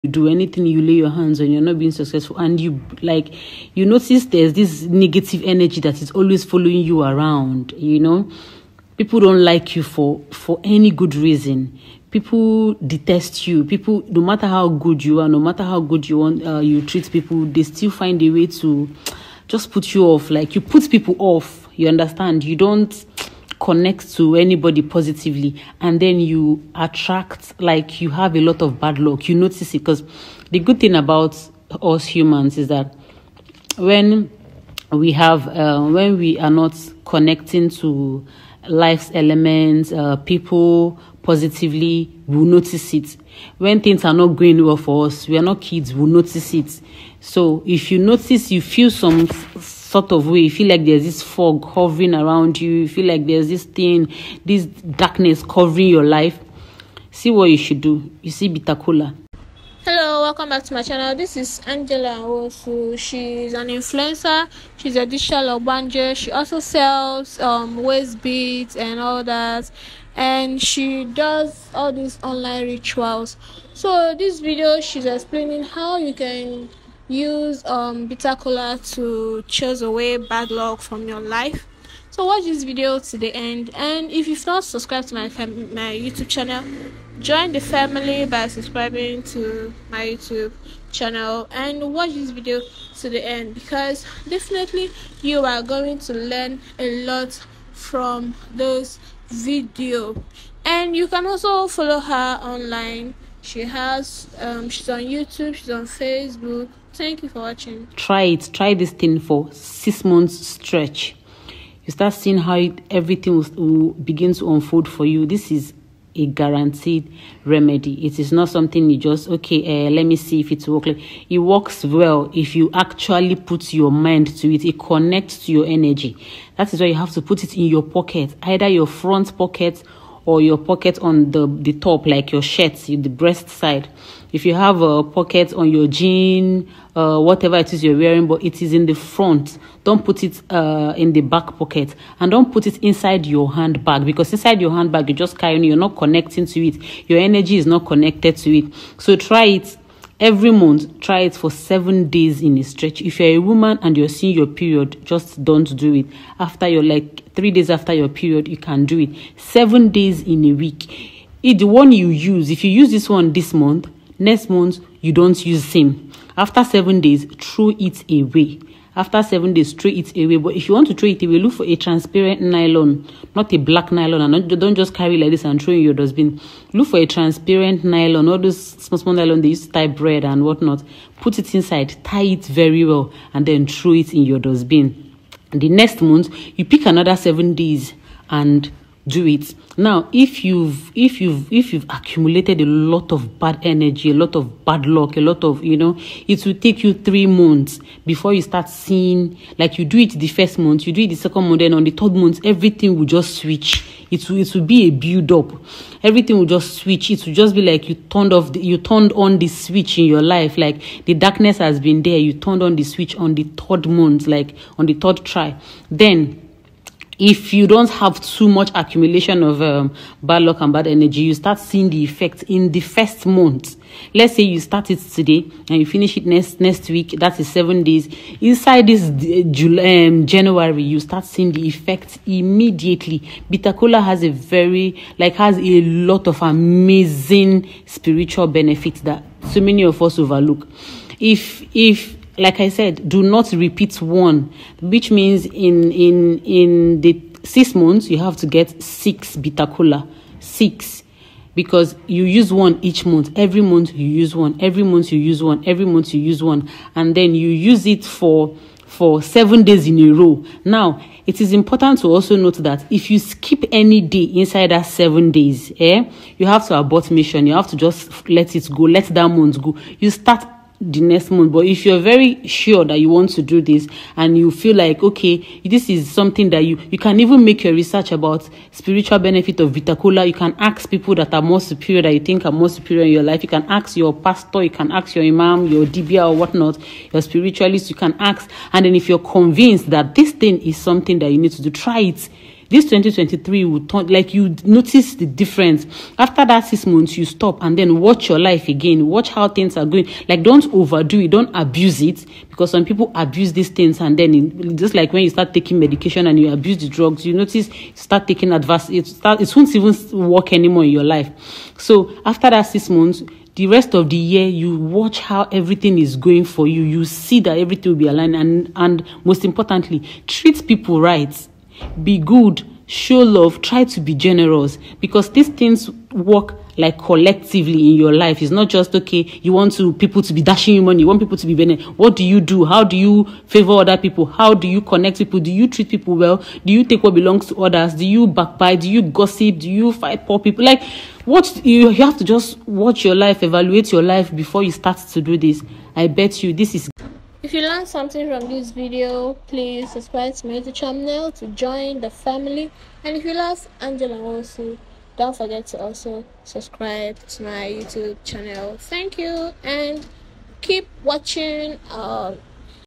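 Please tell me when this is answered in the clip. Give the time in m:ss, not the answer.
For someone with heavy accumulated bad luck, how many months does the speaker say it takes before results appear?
3:16.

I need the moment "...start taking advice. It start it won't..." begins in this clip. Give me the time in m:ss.
5:07.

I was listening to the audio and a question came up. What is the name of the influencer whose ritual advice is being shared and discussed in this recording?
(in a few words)
Angela Nwosu.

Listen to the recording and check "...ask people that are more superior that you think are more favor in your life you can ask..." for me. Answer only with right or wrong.
wrong.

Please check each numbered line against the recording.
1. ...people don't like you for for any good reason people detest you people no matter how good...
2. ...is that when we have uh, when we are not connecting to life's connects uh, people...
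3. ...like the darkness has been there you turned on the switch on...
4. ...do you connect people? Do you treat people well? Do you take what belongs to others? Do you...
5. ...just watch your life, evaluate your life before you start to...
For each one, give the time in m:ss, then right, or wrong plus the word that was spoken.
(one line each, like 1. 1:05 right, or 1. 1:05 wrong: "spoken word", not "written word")
1. 0:08 right
2. 0:32 wrong: "elements", not "connects"
3. 3:30 right
4. 5:34 right
5. 5:42 right.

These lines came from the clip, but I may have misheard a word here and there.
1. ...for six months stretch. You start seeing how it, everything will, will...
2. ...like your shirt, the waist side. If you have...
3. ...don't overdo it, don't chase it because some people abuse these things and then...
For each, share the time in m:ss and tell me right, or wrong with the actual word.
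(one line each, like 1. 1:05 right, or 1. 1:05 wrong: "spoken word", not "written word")
1. 1:49 right
2. 2:12 wrong: "breast", not "waist"
3. 5:00 wrong: "abuse", not "chase".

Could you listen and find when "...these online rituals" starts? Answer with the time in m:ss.
1:11.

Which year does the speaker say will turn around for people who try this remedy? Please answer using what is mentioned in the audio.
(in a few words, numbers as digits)
2023.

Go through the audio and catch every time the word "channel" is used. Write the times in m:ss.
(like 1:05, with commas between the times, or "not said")
1:00, 1:26, 1:30, 5:50, 5:58.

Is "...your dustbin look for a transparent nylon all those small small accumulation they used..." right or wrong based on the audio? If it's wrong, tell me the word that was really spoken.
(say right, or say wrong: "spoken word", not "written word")
wrong: "nylon", not "accumulation".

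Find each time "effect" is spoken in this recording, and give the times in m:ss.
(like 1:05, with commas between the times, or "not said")
3:42, 3:51.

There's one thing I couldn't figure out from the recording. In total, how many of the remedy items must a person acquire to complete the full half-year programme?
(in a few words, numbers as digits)
6.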